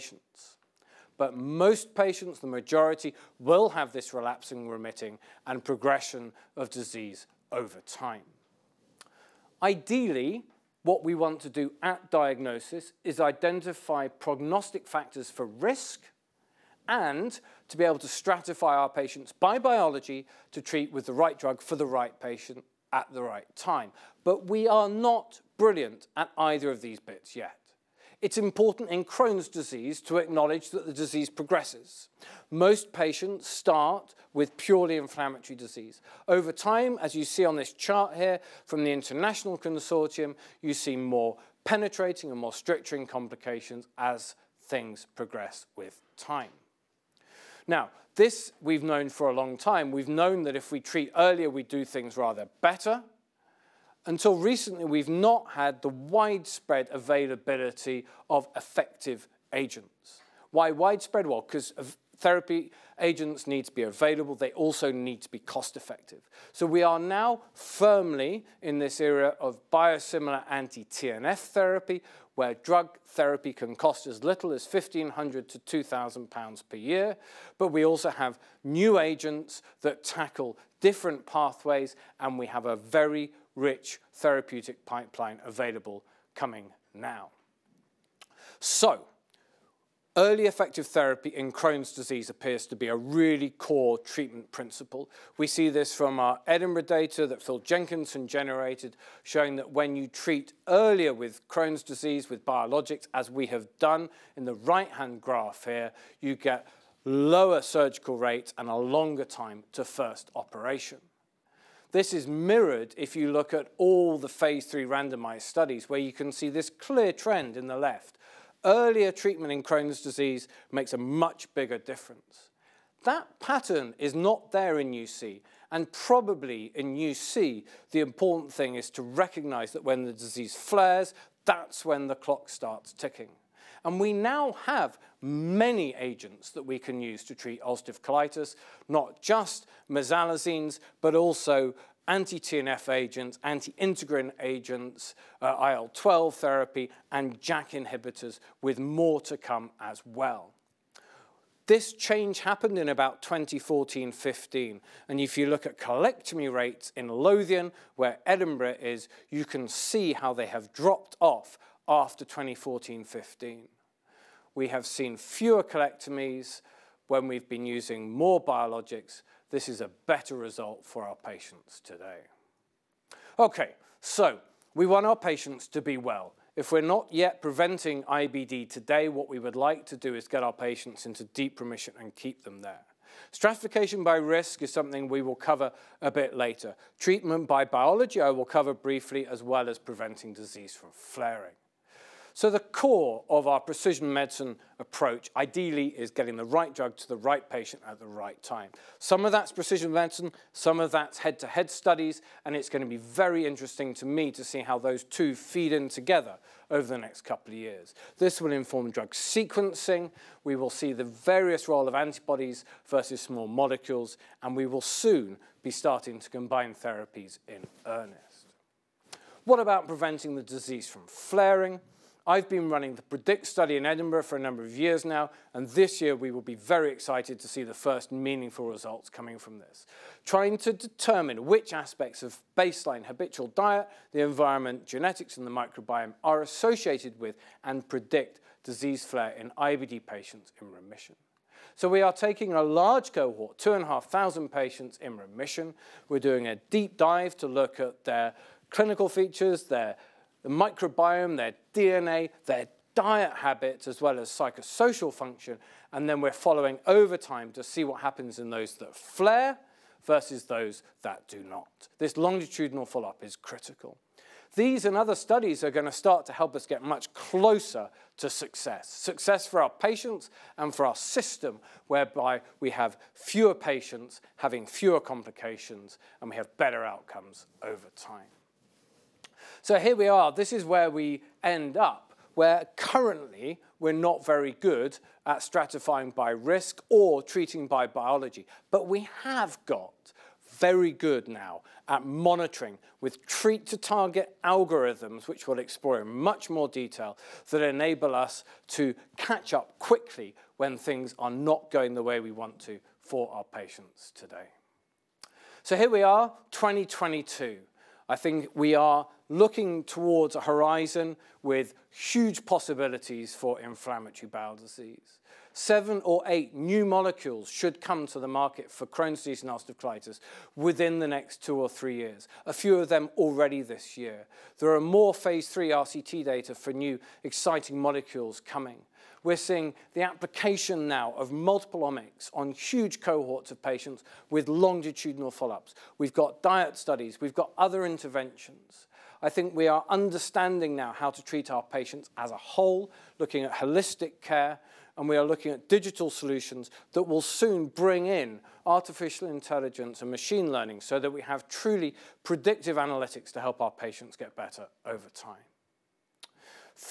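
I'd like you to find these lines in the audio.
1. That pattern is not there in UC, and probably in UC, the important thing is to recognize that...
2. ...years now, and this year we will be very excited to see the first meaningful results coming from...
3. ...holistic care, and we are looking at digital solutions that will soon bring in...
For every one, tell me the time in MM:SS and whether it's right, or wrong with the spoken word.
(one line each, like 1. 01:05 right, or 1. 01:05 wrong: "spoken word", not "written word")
1. 02:03 right
2. 03:44 right
3. 05:43 right.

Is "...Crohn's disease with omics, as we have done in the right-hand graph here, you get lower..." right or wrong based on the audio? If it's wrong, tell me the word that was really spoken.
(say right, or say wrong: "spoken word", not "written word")
wrong: "biologics", not "omics".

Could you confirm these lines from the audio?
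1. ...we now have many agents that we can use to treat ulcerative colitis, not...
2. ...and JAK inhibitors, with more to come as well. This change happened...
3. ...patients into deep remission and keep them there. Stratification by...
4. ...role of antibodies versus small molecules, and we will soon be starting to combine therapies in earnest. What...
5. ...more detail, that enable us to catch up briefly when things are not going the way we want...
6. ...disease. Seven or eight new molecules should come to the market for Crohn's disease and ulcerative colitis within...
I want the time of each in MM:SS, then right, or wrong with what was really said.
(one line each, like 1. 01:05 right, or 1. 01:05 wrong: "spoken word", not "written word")
1. 02:13 right
2. 02:27 right
3. 03:00 right
4. 03:31 right
5. 04:56 wrong: "quickly", not "briefly"
6. 05:14 right.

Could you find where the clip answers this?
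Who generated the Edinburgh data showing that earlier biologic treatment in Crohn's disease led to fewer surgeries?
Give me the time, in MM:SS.
01:37.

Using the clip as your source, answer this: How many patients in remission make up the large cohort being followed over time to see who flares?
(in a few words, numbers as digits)
2,500.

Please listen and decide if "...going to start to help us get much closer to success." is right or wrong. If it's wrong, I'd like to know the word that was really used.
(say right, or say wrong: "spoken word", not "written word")
right.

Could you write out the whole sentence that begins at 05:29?
We're seeing the application now of multiple omics on huge cohorts of patients with longitudinal follow-ups.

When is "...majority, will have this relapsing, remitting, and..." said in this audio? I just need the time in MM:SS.
00:02.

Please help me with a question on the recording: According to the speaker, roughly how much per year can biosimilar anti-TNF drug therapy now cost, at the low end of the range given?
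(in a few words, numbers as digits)
1,500 pounds.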